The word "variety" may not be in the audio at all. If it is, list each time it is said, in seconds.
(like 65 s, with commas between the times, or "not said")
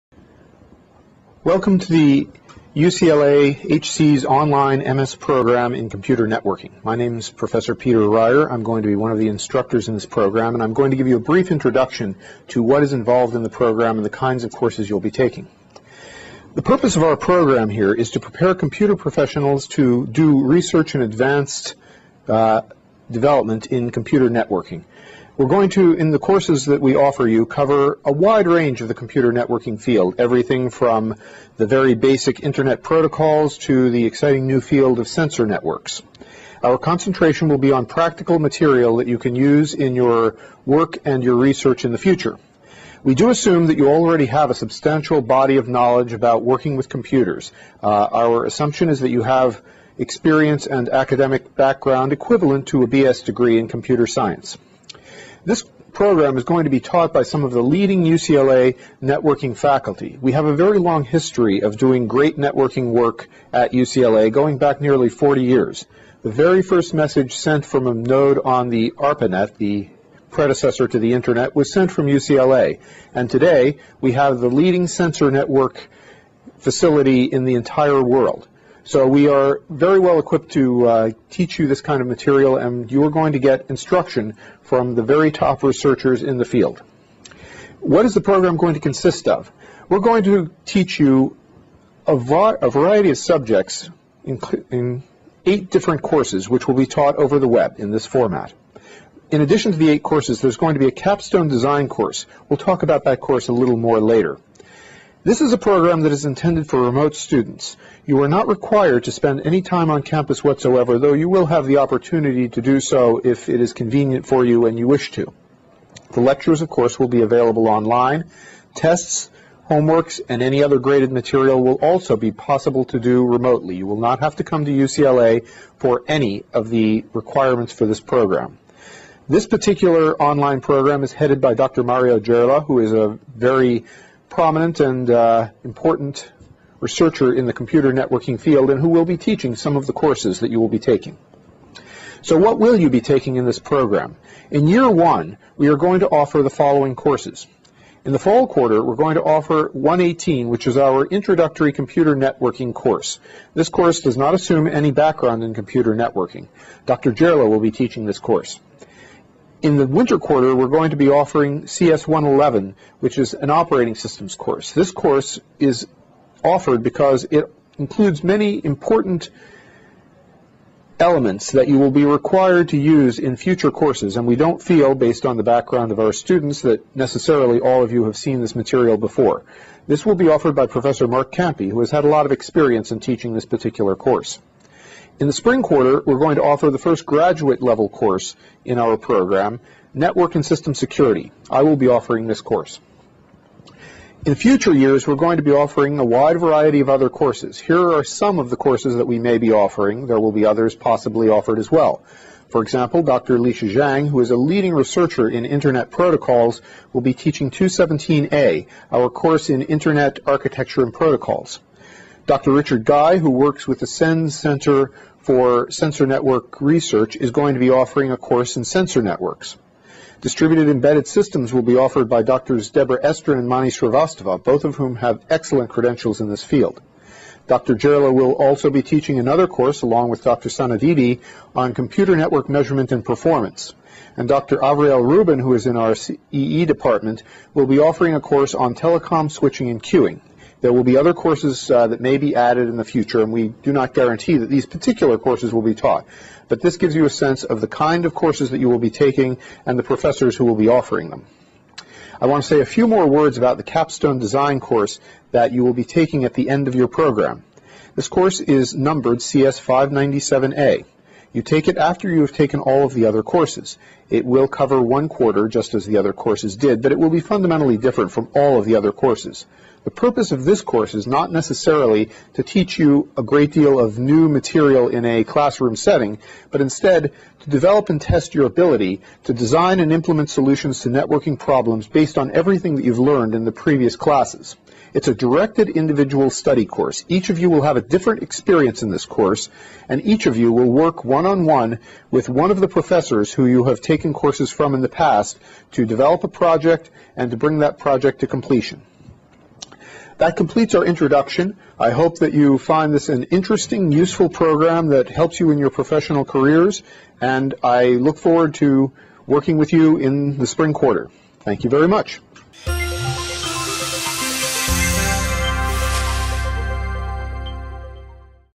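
92 s, 196 s.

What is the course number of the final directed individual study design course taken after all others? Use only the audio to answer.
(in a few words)
CS597A.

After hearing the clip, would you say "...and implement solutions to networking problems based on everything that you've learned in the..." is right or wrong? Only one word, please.
right.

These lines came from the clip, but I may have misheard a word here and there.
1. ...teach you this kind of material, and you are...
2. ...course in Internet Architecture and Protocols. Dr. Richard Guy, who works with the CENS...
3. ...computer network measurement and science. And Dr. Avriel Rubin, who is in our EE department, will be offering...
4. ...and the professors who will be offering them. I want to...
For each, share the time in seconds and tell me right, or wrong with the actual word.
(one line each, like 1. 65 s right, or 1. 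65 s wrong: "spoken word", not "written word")
1. 81 s right
2. 209 s right
3. 231 s wrong: "performance", not "science"
4. 249 s right.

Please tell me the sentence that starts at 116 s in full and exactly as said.
The lectures, of course, will be available online.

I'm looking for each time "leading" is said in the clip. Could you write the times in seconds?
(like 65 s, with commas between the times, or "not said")
57 s, 74 s, 204 s.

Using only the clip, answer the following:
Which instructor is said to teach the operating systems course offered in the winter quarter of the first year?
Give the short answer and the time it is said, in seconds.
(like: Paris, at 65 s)
Mark Kampe, at 180 s.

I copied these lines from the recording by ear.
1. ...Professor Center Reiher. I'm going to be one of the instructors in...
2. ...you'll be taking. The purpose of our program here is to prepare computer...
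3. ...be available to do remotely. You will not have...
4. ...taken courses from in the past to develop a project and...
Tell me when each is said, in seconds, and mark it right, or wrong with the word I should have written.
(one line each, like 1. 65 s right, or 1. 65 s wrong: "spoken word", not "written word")
1. 7 s wrong: "Peter", not "Center"
2. 14 s right
3. 122 s wrong: "possible", not "available"
4. 293 s right.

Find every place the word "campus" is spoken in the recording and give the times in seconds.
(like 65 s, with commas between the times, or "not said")
110 s.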